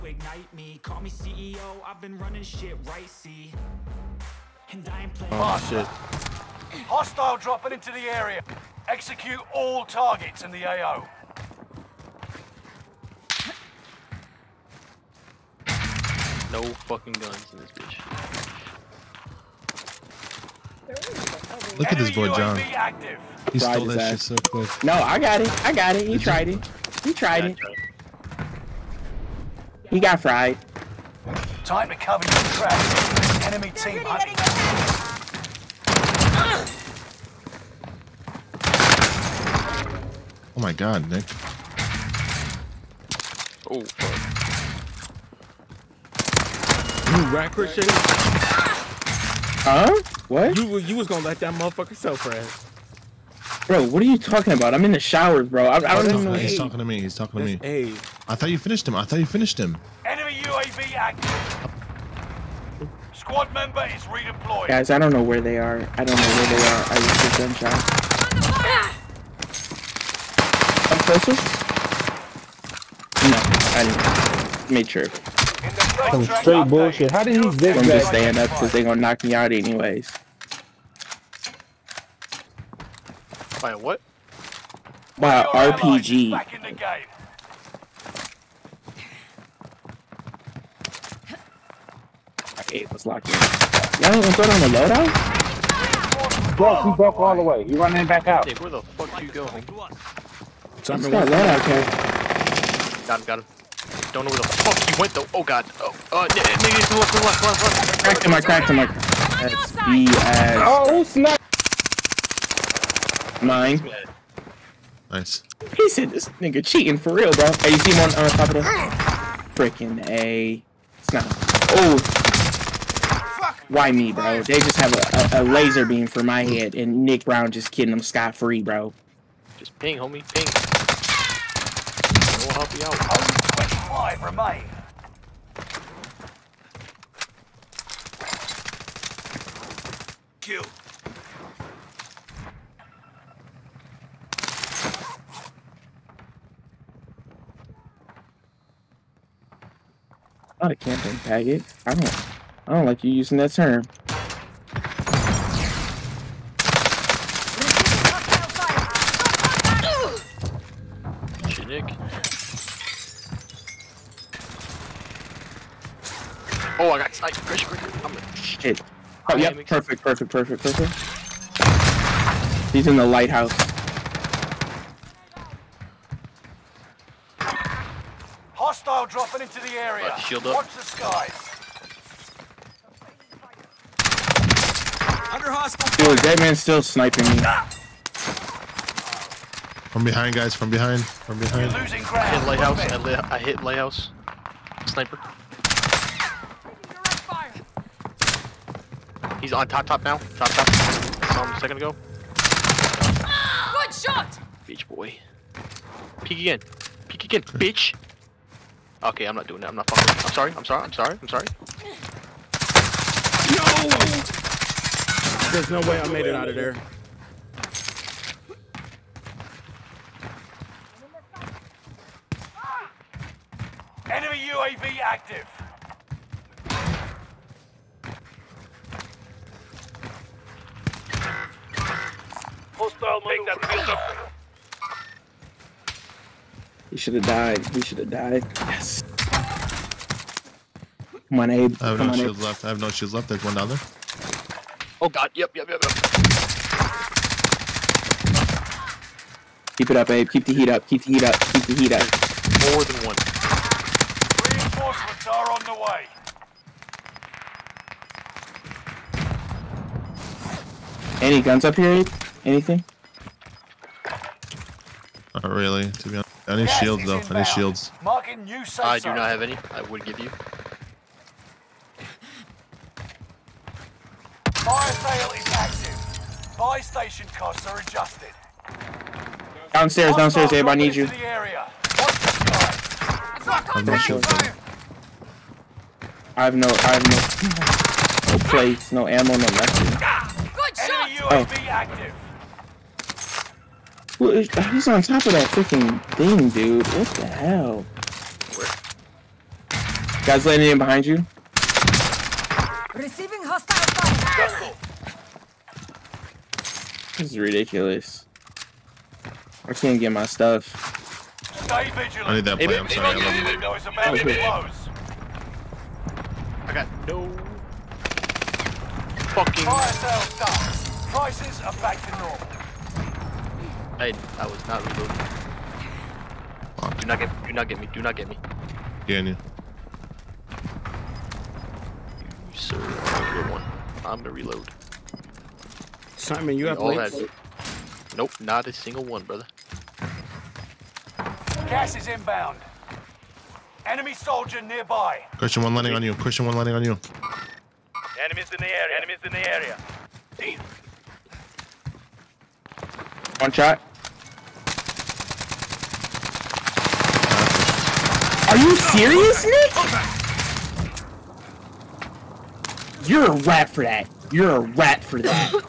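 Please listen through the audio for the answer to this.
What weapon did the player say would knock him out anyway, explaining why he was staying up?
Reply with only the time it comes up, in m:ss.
1:25.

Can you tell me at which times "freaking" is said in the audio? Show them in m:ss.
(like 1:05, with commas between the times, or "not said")
1:59, 4:55.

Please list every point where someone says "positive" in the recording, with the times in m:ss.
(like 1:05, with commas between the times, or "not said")
not said.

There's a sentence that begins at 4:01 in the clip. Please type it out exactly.
I have Come no shields left.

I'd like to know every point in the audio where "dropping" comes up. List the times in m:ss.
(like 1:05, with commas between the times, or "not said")
0:07, 2:59.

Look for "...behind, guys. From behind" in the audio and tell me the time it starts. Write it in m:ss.
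3:10.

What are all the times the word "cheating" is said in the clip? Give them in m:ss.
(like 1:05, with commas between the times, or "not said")
1:56.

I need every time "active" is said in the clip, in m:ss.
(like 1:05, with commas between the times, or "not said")
1:00, 3:44, 4:35.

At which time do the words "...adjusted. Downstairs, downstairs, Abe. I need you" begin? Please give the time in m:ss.
4:37.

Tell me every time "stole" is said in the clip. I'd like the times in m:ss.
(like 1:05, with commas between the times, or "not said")
0:23.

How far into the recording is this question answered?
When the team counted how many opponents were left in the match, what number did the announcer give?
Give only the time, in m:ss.
2:13.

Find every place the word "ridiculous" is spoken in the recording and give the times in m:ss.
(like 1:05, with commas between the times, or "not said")
5:07.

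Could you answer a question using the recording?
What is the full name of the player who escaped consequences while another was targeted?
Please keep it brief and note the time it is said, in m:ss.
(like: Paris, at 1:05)
Nick Brown, at 2:07.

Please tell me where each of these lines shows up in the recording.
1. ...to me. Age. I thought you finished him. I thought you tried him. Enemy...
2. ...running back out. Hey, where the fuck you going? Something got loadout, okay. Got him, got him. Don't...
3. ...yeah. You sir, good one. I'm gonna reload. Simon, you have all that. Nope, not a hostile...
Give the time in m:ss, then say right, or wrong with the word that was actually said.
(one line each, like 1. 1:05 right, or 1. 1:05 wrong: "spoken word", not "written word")
1. 0:57 wrong: "finished", not "tried"
2. 1:37 right
3. 5:29 wrong: "single", not "hostile".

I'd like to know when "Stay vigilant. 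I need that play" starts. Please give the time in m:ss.
5:11.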